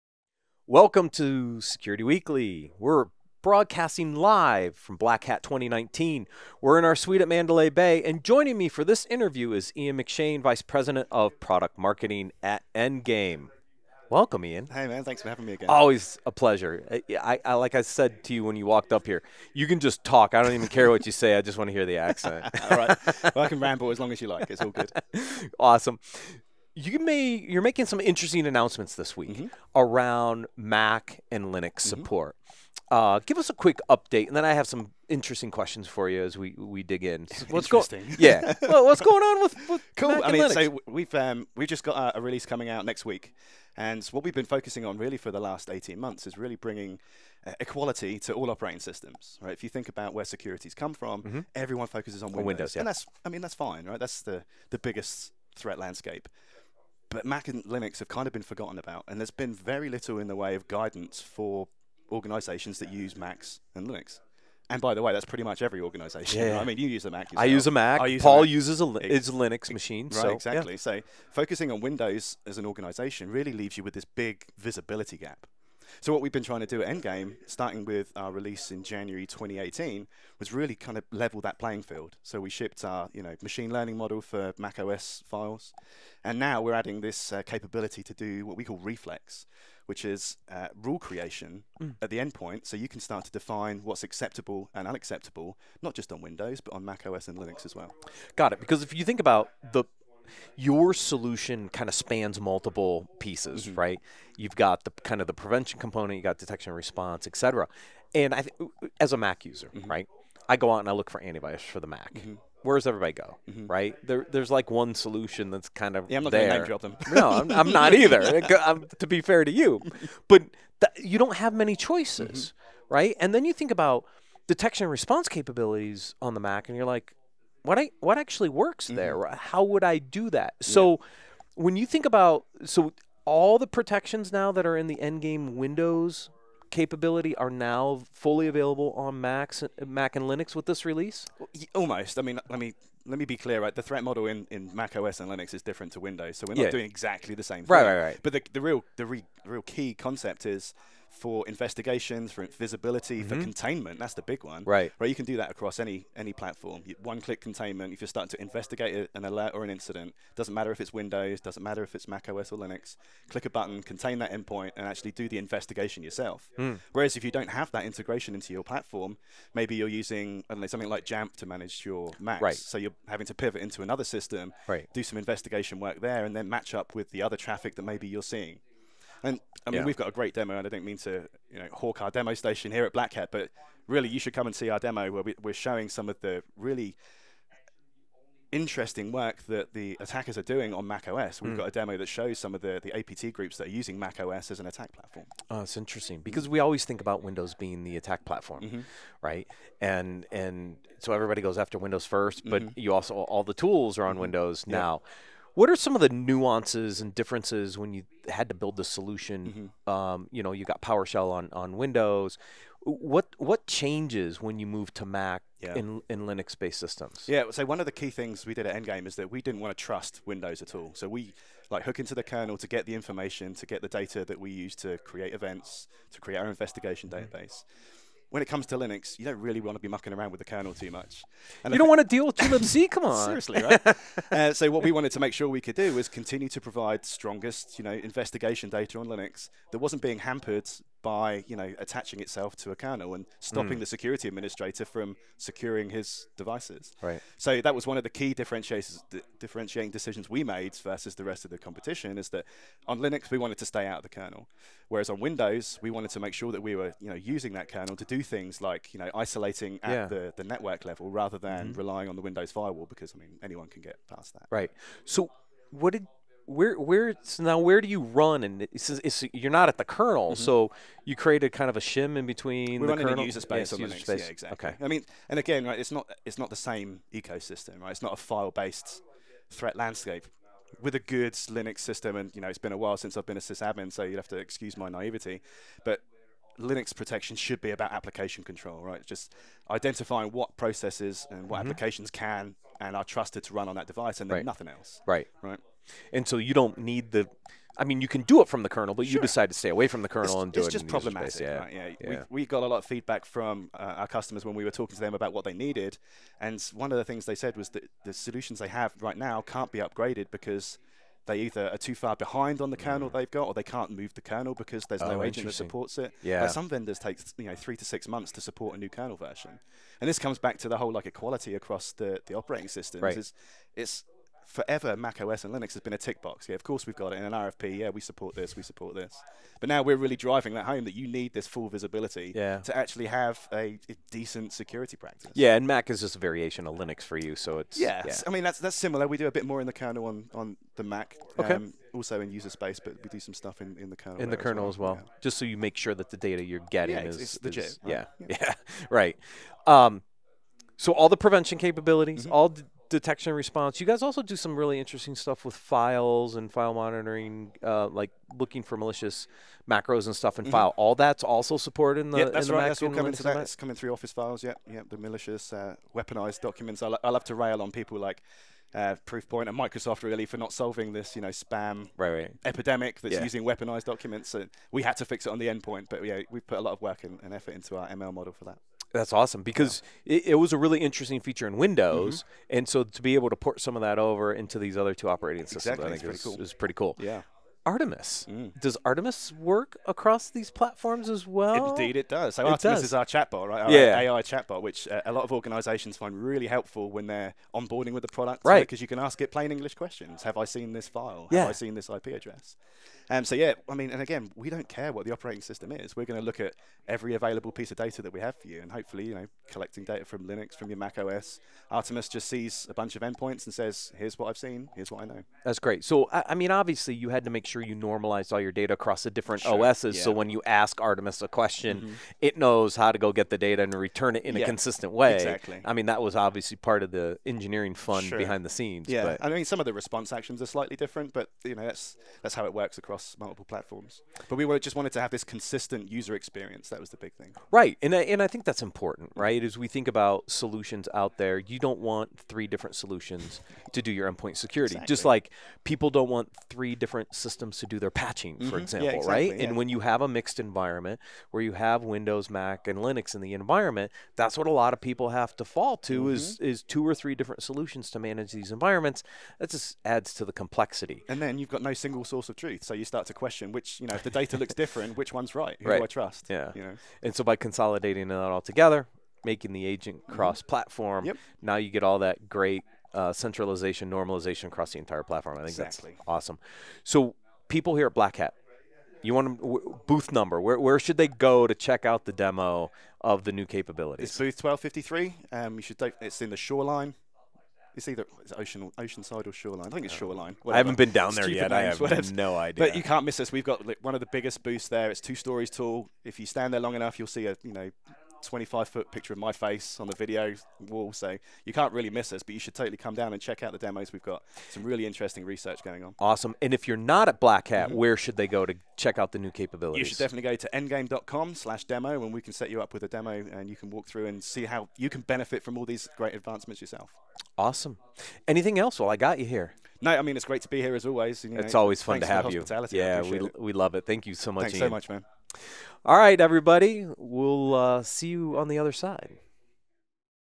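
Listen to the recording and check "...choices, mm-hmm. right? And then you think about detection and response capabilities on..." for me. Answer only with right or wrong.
right.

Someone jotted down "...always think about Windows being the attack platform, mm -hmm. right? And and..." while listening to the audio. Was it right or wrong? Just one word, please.
right.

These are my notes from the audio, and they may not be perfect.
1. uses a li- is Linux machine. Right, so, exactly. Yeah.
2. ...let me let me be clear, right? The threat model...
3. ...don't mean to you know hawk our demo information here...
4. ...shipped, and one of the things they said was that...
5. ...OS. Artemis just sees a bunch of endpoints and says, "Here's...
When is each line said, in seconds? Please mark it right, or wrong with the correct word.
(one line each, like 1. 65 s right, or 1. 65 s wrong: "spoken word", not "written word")
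1. 68 s right
2. 142 s right
3. 180 s wrong: "station", not "information"
4. 305 s wrong: "needed", not "shipped"
5. 410 s right.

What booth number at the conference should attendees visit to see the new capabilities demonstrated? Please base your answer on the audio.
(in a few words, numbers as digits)
1253.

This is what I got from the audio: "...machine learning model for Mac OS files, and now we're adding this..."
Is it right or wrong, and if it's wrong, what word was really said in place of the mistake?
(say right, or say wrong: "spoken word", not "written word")
right.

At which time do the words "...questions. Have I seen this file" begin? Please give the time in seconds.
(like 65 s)
399 s.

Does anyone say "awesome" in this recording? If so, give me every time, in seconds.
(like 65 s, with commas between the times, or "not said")
25 s, 379 s, 476 s, 505 s, 517 s.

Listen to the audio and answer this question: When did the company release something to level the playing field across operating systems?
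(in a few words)
January 2018.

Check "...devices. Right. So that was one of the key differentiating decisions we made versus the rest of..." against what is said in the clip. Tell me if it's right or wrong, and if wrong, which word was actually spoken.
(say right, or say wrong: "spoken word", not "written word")
right.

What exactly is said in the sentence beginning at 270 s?
so you created kind of a shim in between we the run kernel in user space yes, user Linux.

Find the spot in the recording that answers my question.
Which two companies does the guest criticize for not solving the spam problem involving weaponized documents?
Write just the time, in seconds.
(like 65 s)
369 s.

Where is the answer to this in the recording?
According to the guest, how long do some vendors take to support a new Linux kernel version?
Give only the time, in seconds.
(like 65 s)
317 s.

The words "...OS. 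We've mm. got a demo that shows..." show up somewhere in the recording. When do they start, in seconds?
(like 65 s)
191 s.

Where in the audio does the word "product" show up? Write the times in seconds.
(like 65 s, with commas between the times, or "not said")
11 s, 398 s.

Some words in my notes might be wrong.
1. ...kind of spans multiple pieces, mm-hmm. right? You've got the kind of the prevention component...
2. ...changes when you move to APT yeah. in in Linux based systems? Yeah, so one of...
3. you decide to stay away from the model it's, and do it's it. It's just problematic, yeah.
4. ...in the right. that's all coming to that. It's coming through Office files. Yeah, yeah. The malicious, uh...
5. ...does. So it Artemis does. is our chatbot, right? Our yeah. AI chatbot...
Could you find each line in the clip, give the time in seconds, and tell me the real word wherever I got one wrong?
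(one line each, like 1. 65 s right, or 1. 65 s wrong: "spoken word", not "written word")
1. 101 s right
2. 213 s wrong: "Mac", not "APT"
3. 299 s wrong: "kernel", not "model"
4. 362 s right
5. 392 s right.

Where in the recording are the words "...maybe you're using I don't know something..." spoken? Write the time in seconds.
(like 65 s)
169 s.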